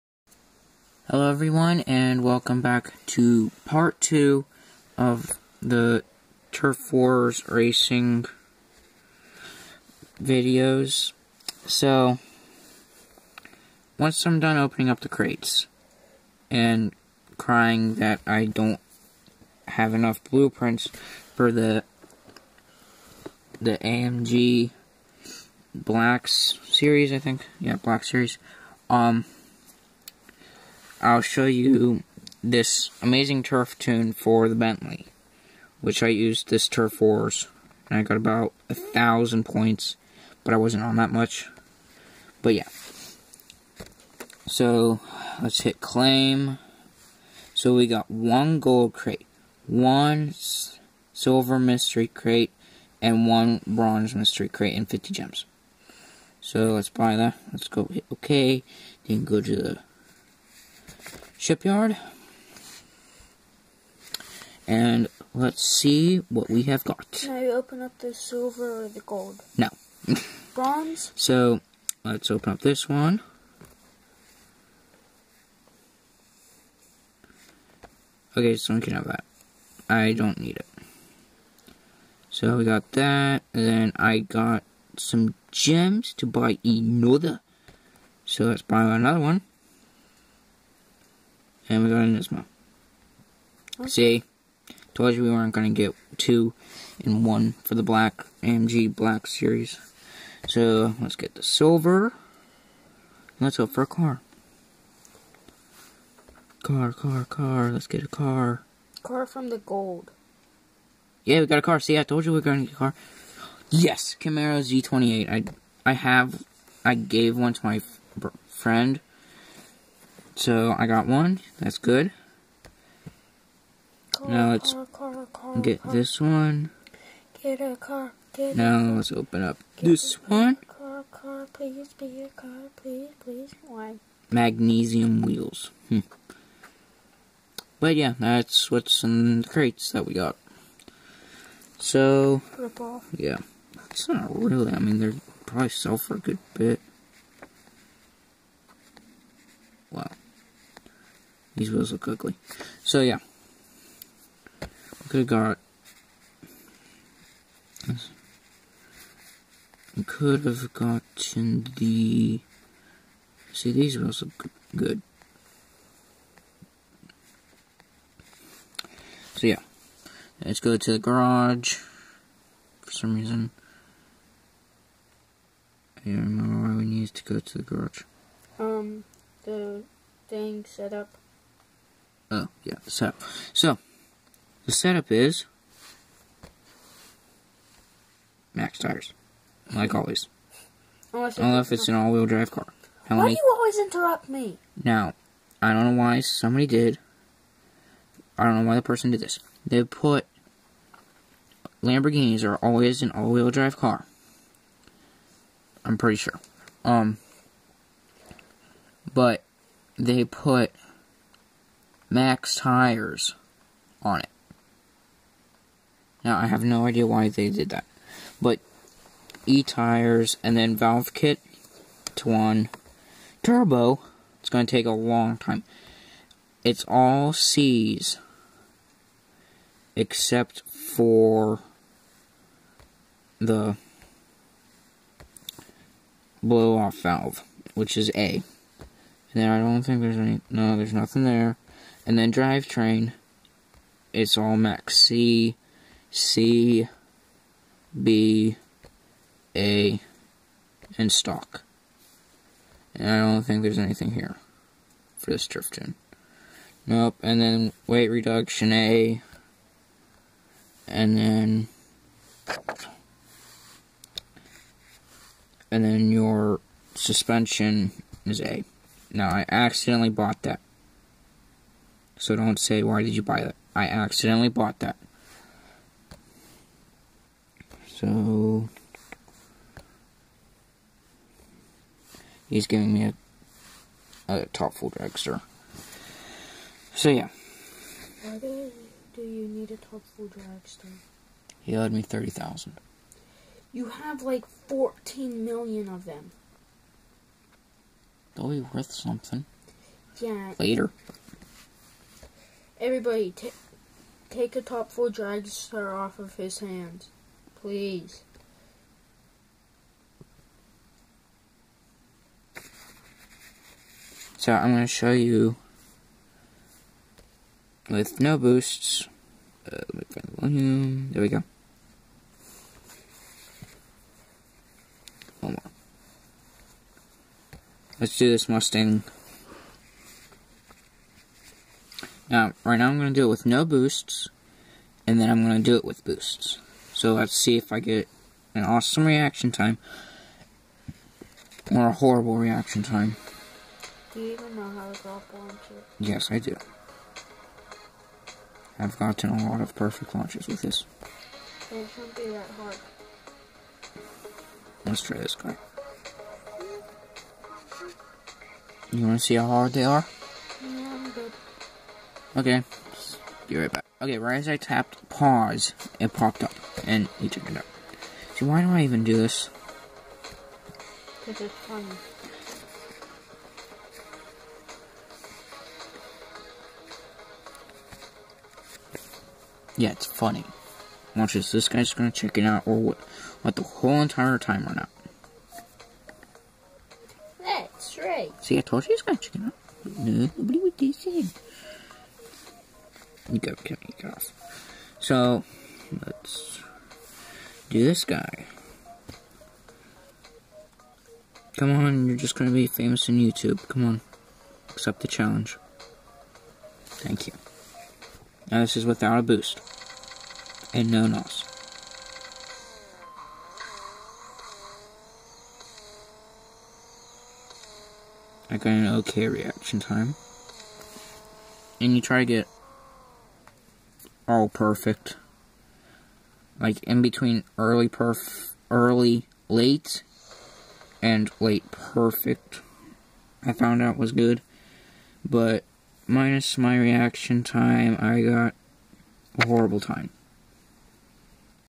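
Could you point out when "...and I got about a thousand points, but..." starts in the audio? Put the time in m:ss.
0:37.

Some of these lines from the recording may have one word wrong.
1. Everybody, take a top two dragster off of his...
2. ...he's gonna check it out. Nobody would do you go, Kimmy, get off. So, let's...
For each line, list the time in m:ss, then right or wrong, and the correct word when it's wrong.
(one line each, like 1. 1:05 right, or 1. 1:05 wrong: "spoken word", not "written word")
1. 5:02 wrong: "four", not "two"
2. 6:28 right.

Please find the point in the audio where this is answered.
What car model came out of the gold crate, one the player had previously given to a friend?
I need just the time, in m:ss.
1:54.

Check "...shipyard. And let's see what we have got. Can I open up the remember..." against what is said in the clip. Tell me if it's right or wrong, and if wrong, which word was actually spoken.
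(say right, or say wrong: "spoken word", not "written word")
wrong: "silver", not "remember".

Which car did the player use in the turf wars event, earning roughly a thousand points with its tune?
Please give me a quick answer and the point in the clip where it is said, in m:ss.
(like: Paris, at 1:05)
Bentley, at 0:34.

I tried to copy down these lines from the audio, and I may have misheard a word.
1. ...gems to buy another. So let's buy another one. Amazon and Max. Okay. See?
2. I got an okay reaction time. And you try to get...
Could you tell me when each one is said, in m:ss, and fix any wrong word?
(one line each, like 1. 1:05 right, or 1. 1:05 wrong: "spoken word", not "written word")
1. 1:25 wrong: "Isma", not "Max"
2. 6:58 right.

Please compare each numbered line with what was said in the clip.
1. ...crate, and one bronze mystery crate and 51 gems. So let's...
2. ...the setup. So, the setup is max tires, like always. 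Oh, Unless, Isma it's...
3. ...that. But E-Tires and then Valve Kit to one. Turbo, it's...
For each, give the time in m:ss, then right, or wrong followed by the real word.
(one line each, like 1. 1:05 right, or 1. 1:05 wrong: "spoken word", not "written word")
1. 0:52 wrong: "50", not "51"
2. 3:02 wrong: "Unless", not "Isma"
3. 3:37 right.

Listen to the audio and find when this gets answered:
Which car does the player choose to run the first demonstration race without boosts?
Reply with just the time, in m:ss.
5:28.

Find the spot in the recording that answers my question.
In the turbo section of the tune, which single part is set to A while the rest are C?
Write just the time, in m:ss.
3:56.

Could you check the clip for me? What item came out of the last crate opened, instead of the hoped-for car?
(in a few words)
Magnesium wheels.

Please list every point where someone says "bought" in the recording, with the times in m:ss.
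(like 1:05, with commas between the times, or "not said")
4:30, 4:34.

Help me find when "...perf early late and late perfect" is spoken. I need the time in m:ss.
7:07.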